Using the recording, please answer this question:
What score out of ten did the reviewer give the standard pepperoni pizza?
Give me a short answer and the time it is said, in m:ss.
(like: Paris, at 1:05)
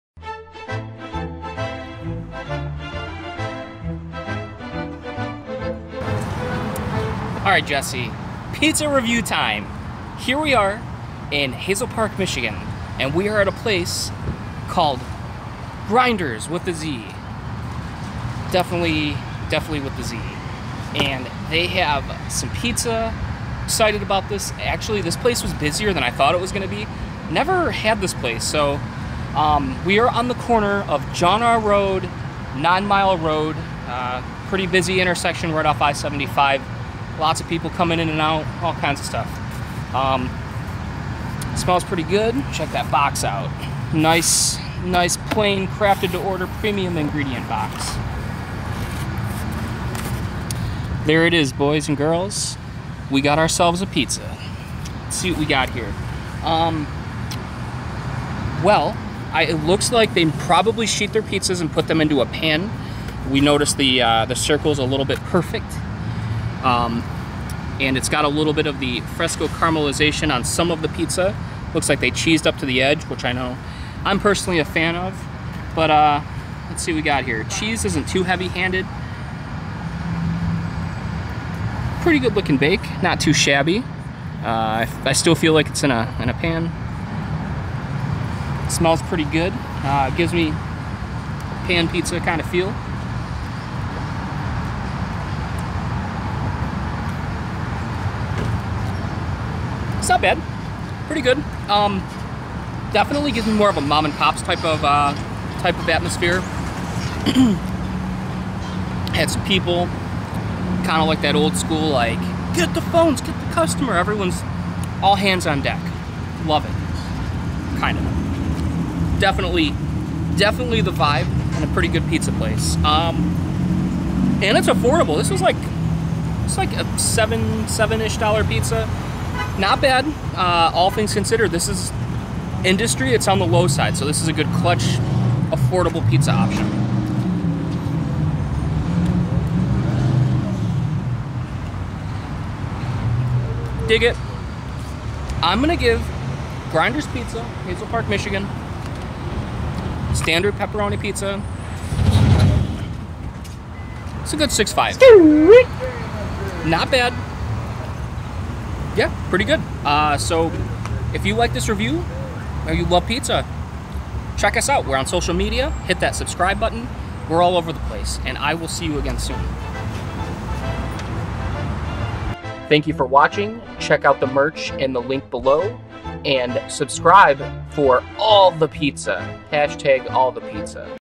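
6.5, at 2:34.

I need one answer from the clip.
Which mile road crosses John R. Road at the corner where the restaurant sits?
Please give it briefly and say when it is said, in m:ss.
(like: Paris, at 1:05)
Nine Mile Road, at 0:32.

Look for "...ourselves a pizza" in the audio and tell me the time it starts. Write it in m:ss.
0:53.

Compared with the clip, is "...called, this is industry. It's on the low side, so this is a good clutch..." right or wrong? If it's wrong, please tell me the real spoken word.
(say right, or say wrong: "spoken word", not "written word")
wrong: "considered", not "called".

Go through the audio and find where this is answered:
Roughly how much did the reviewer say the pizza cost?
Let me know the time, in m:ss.
2:07.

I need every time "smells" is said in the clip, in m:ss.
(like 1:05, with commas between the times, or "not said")
0:41, 1:28.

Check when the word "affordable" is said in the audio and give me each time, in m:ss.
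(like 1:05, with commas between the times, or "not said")
2:04, 2:15.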